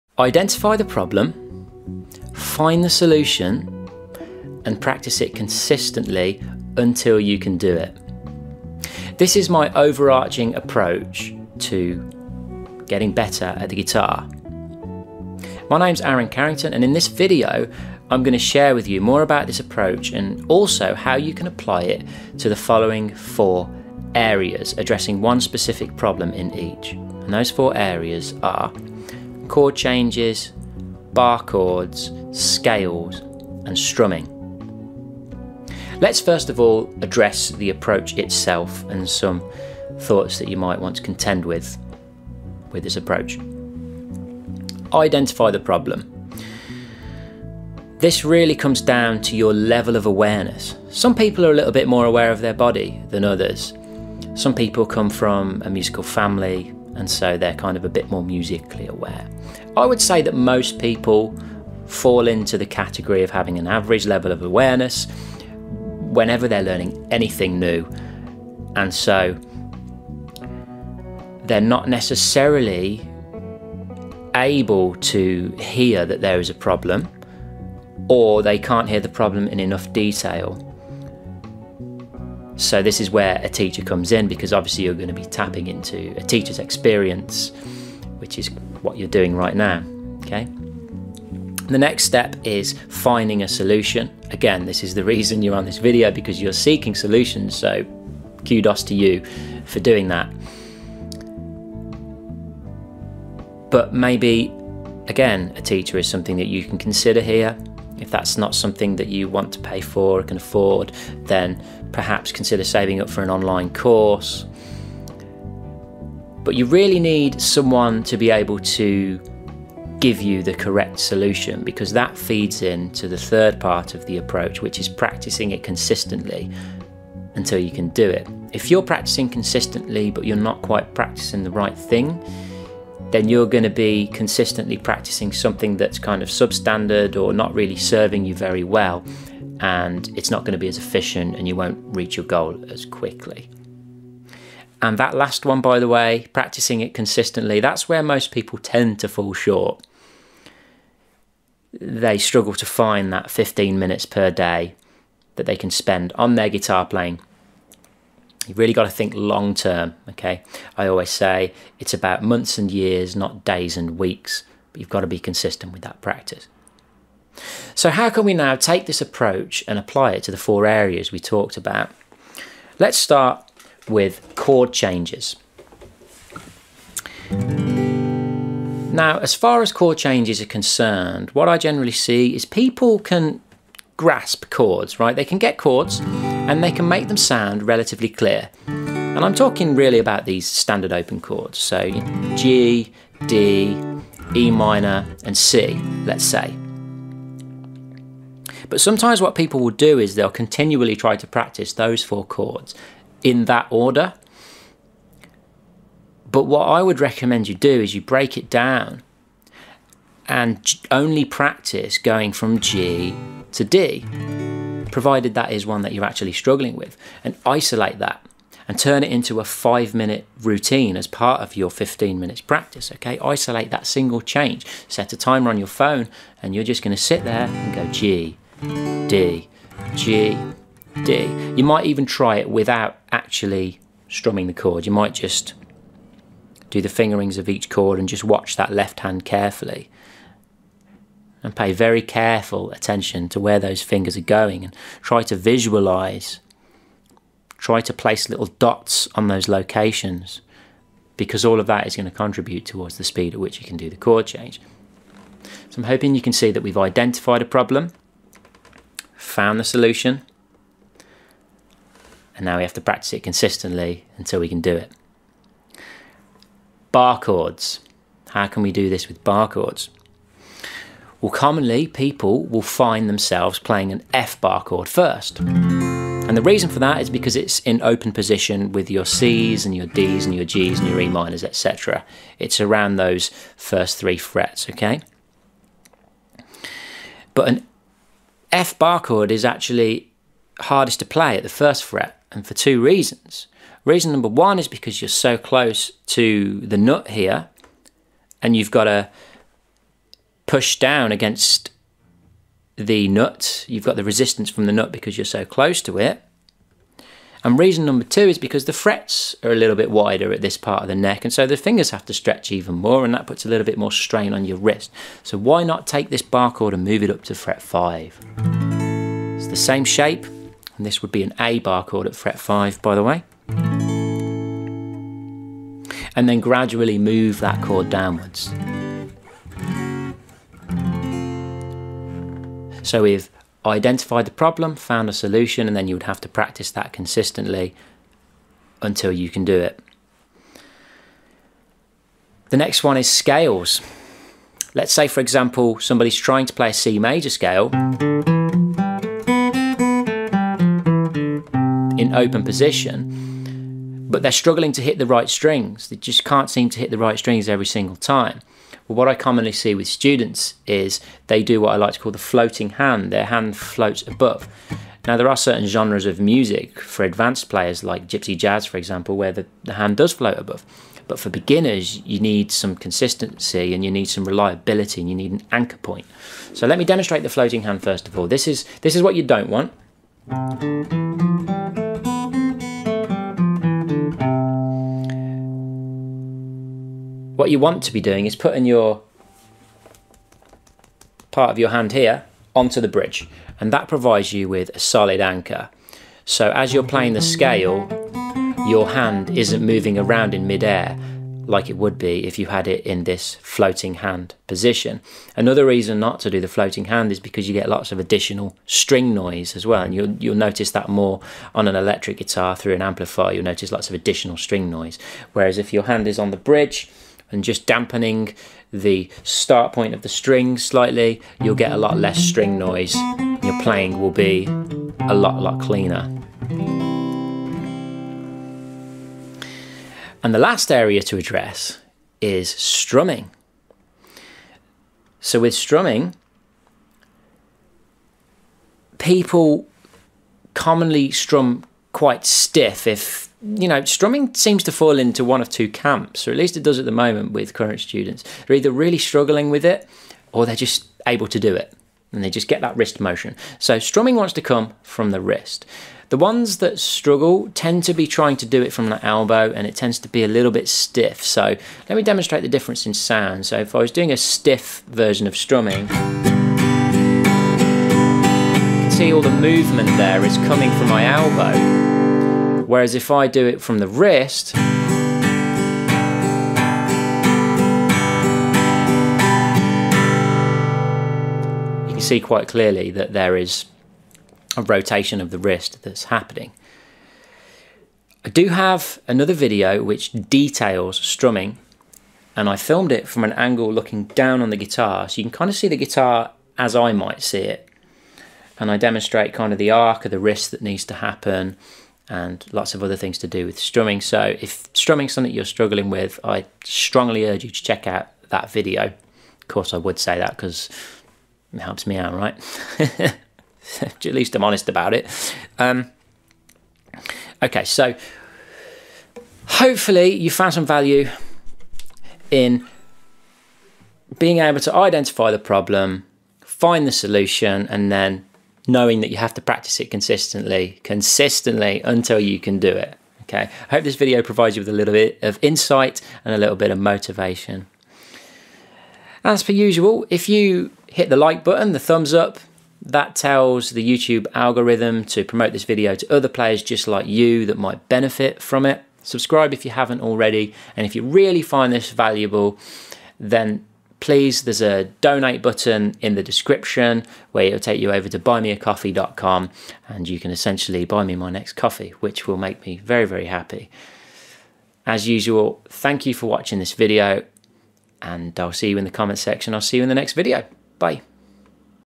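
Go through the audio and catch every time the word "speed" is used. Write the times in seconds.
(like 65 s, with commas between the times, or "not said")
253 s.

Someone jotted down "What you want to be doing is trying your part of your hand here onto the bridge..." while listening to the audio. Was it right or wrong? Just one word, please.
wrong.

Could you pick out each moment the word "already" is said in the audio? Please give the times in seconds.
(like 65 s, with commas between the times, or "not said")
550 s.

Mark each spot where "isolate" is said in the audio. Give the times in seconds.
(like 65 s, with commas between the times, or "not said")
217 s, 223 s.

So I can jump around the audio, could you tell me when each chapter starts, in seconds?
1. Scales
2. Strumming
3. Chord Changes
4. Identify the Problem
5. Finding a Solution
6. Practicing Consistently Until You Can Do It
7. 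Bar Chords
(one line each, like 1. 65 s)
1. 341 s
2. 429 s
3. 171 s
4. 44 s
5. 91 s
6. 121 s
7. 265 s.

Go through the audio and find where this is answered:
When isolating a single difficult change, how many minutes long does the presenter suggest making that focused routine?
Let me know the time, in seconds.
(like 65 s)
219 s.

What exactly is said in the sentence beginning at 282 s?
It's around those first three frets, okay?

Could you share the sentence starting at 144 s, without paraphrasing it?
And that last one, by the way, practicing it consistently, that's where most people tend to fall short.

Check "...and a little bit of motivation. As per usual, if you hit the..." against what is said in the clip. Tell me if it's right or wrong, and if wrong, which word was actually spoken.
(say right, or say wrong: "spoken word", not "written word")
right.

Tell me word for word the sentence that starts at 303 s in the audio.
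You've got the resistance from the nut because you're so close to it.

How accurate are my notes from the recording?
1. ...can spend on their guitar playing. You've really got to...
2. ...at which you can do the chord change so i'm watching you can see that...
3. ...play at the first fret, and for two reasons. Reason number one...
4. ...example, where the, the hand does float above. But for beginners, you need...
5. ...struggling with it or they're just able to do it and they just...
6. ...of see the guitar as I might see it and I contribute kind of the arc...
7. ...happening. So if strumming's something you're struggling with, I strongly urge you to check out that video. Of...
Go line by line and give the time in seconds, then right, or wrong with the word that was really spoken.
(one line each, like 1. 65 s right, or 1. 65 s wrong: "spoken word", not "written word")
1. 155 s right
2. 253 s wrong: "hoping", not "watching"
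3. 291 s right
4. 368 s right
5. 448 s right
6. 495 s wrong: "demonstrate", not "contribute"
7. 503 s wrong: "strumming", not "happening".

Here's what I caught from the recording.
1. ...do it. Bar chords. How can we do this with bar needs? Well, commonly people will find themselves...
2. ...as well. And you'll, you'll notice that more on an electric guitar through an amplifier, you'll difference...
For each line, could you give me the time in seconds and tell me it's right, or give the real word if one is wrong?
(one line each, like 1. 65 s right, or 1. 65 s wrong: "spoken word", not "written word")
1. 264 s wrong: "chords", not "needs"
2. 409 s wrong: "notice", not "difference".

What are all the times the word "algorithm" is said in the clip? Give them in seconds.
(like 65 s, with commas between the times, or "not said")
544 s.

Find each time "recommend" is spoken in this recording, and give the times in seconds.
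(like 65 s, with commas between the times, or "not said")
207 s.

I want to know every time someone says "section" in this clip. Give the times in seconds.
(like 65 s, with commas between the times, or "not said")
569 s.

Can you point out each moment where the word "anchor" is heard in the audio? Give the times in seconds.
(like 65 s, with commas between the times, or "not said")
375 s, 395 s.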